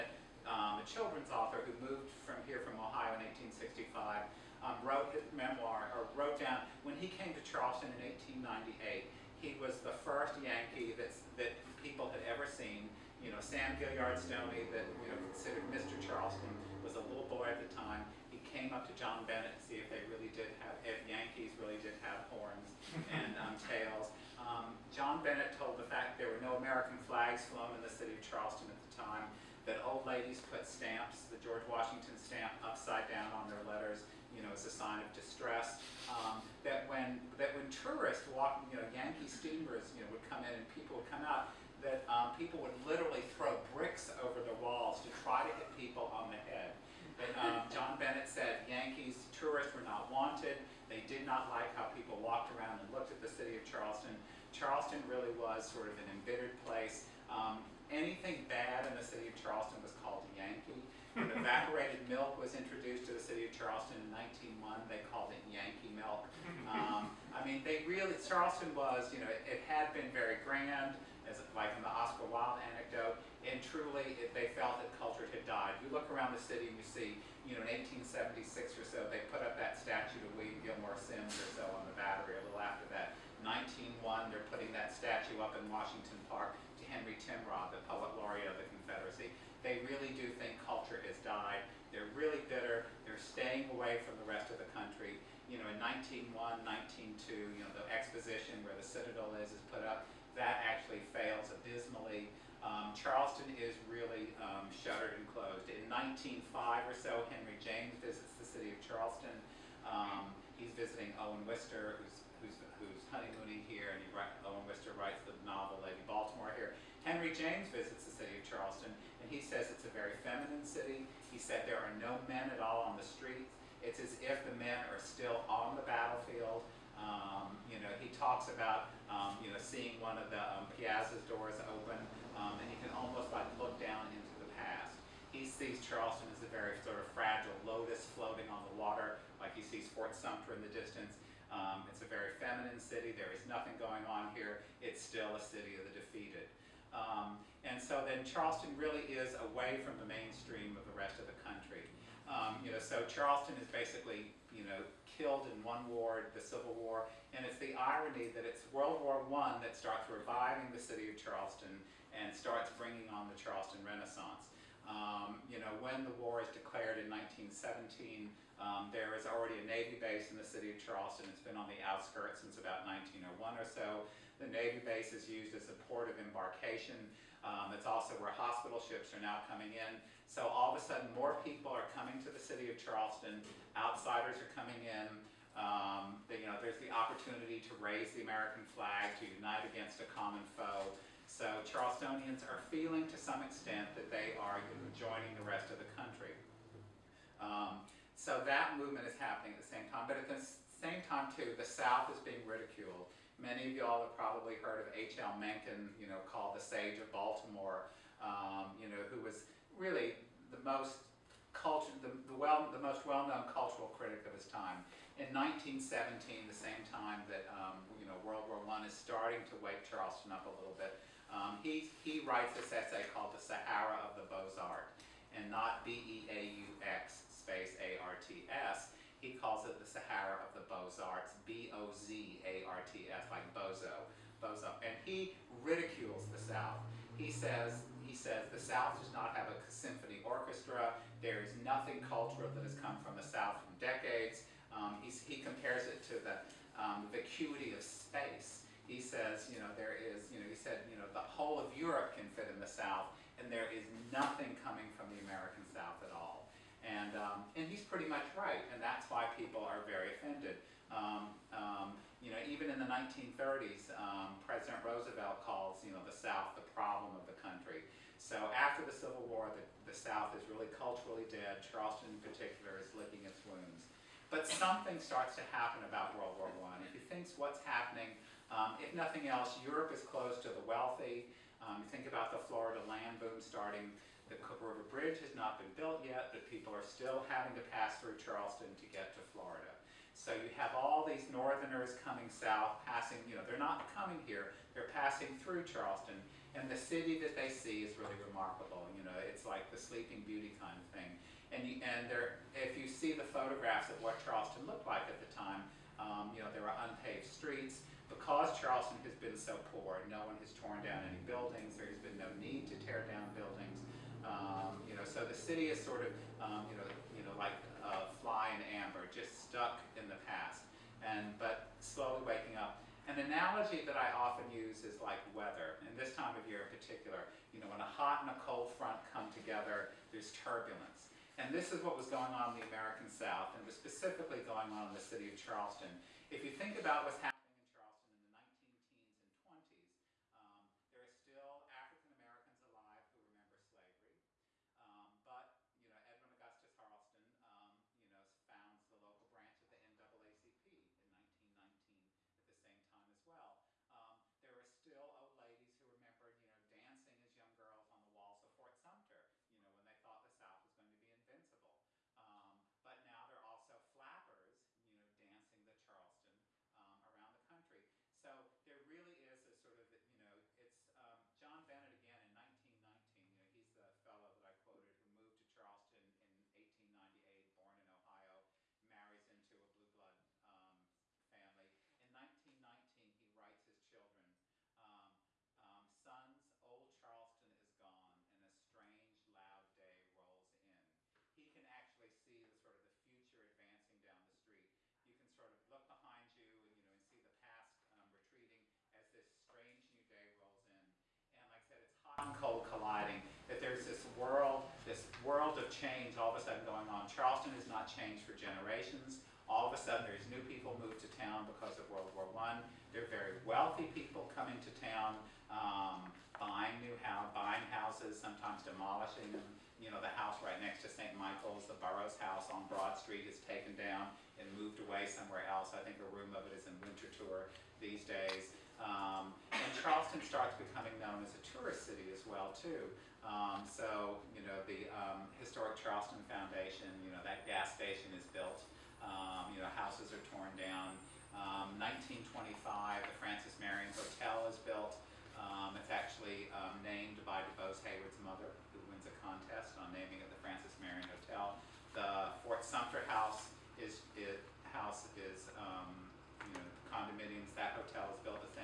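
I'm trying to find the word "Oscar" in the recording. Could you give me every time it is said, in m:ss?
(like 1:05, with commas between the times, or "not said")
1:11.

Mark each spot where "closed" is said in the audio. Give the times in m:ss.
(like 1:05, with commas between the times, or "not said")
1:45, 4:40.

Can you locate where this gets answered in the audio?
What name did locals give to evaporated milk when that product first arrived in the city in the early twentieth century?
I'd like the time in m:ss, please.
1:05.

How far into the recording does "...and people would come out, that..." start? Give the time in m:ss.
0:40.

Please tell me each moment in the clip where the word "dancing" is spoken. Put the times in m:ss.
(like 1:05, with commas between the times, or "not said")
5:56, 6:05.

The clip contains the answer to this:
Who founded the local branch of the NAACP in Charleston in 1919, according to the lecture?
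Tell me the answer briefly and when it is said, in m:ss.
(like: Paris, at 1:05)
Edwin Augustus Harleston, at 5:46.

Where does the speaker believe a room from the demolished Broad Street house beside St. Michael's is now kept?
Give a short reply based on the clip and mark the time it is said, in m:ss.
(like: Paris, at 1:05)
Winterthur, at 7:06.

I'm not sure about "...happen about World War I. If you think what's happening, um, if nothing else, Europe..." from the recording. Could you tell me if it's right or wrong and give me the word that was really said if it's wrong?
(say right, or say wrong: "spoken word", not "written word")
right.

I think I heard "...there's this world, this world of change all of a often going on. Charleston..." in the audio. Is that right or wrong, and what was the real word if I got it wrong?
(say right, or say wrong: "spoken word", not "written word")
wrong: "sudden", not "often".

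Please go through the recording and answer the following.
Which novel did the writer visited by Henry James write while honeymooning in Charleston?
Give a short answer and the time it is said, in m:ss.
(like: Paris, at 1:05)
Lady Baltimore, at 1:55.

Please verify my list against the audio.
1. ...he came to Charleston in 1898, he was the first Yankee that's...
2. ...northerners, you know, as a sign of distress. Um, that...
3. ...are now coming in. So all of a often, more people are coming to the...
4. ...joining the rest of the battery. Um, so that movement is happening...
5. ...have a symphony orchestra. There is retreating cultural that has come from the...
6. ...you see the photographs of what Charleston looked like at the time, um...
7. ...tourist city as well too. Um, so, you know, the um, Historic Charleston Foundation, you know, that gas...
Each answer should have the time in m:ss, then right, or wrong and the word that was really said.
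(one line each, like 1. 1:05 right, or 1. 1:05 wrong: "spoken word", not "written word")
1. 0:06 right
2. 0:33 wrong: "letters", not "northerners"
3. 2:59 wrong: "sudden", not "often"
4. 3:14 wrong: "country", not "battery"
5. 3:59 wrong: "nothing", not "retreating"
6. 5:02 right
7. 7:11 right.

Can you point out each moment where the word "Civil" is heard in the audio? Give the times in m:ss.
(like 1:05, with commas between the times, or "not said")
2:36, 4:28.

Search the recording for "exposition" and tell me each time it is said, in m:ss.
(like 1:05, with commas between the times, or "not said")
1:37.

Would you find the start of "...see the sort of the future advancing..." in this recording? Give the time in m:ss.
6:32.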